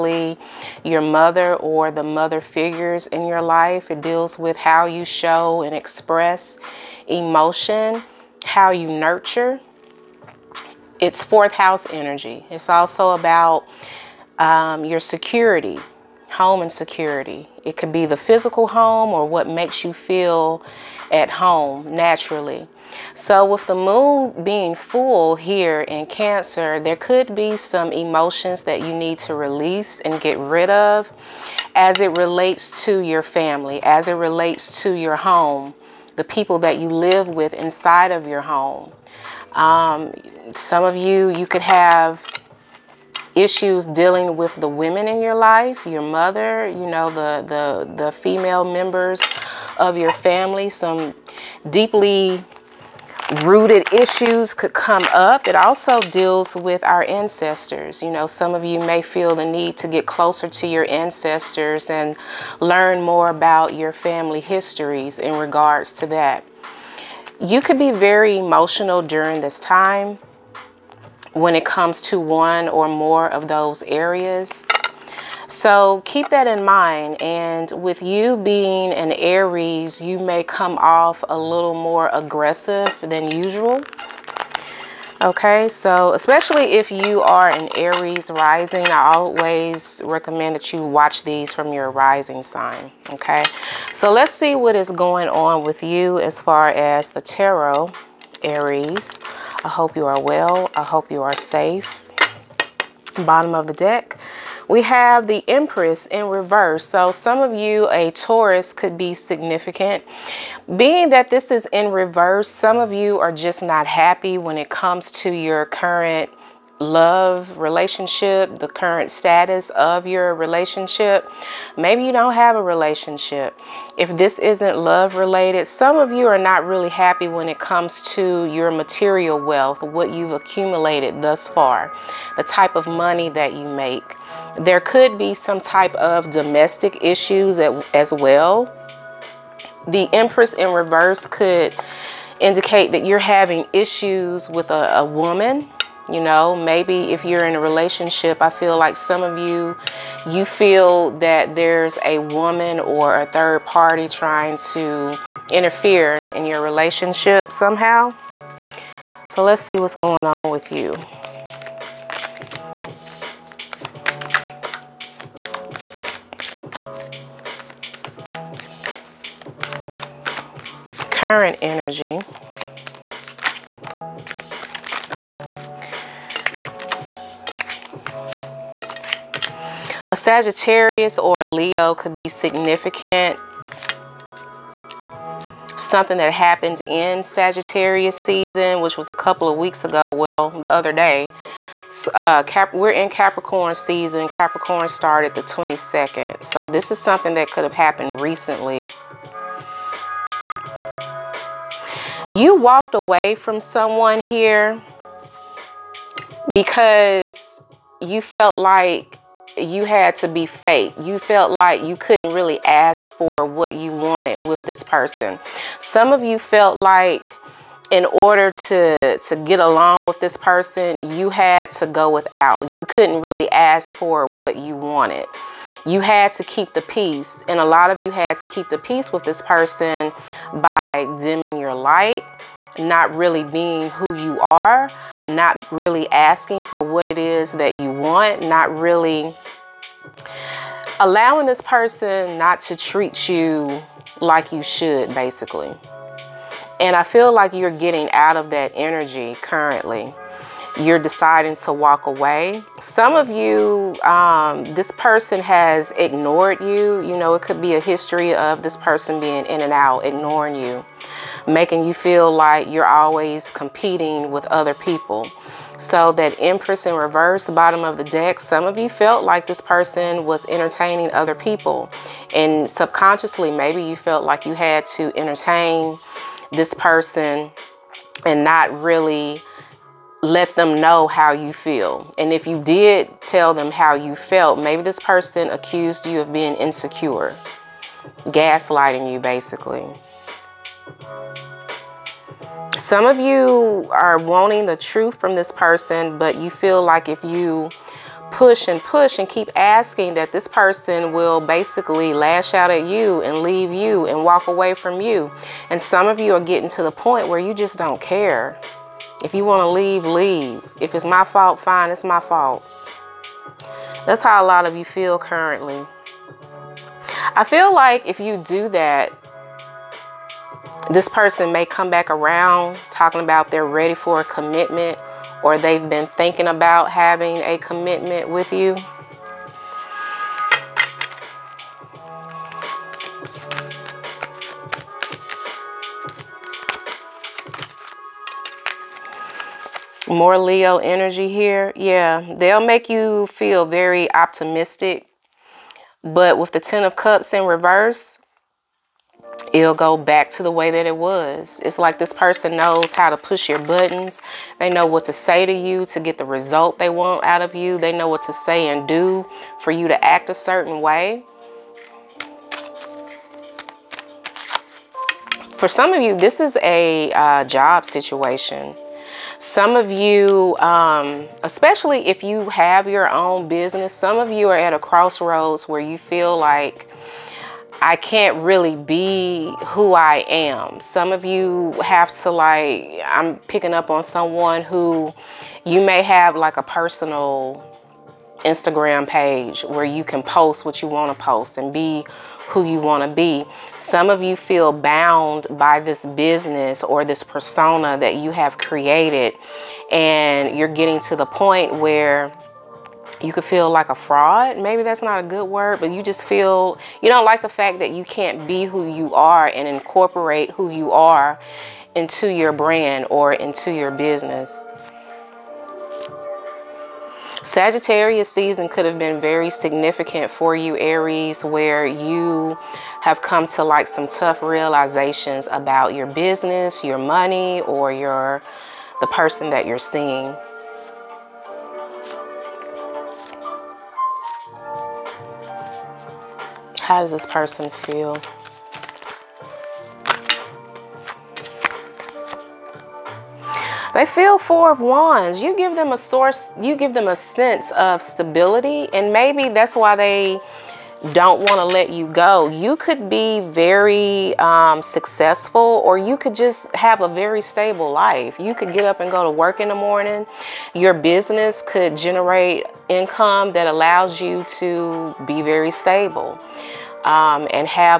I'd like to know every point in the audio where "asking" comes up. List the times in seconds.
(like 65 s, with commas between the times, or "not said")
236 s, 299 s.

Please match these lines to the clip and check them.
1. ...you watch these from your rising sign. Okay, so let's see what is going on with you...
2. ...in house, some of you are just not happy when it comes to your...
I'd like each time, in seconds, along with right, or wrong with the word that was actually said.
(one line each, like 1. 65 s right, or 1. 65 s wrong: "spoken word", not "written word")
1. 90 s right
2. 111 s wrong: "reverse", not "house".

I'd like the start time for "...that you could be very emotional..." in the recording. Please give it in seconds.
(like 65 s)
66 s.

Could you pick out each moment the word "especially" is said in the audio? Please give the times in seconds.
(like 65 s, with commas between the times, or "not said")
86 s, 371 s.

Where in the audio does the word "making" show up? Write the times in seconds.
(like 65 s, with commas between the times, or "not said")
261 s.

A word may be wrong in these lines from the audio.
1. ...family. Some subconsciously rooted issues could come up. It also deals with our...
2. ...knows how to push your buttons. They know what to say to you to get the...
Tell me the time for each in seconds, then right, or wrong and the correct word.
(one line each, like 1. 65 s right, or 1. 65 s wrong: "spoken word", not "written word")
1. 50 s wrong: "deeply", not "subconsciously"
2. 352 s right.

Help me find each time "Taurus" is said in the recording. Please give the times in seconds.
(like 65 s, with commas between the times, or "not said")
108 s.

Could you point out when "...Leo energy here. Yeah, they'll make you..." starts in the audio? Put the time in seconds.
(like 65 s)
340 s.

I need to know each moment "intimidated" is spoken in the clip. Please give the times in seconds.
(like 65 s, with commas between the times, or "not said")
not said.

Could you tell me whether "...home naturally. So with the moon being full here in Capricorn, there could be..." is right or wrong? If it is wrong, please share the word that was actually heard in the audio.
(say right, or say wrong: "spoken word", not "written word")
wrong: "Cancer", not "Capricorn".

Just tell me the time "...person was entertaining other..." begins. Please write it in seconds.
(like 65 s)
269 s.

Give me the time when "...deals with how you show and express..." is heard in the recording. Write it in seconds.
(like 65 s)
4 s.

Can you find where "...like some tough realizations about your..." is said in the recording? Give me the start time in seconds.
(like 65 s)
423 s.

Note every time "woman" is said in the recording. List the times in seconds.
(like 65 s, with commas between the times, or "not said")
145 s, 152 s.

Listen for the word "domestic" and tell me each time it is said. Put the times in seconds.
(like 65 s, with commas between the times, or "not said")
136 s.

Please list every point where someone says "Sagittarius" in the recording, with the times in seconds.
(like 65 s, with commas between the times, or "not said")
180 s, 187 s, 417 s.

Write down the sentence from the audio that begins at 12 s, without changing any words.
It's also about um, your security, home and security.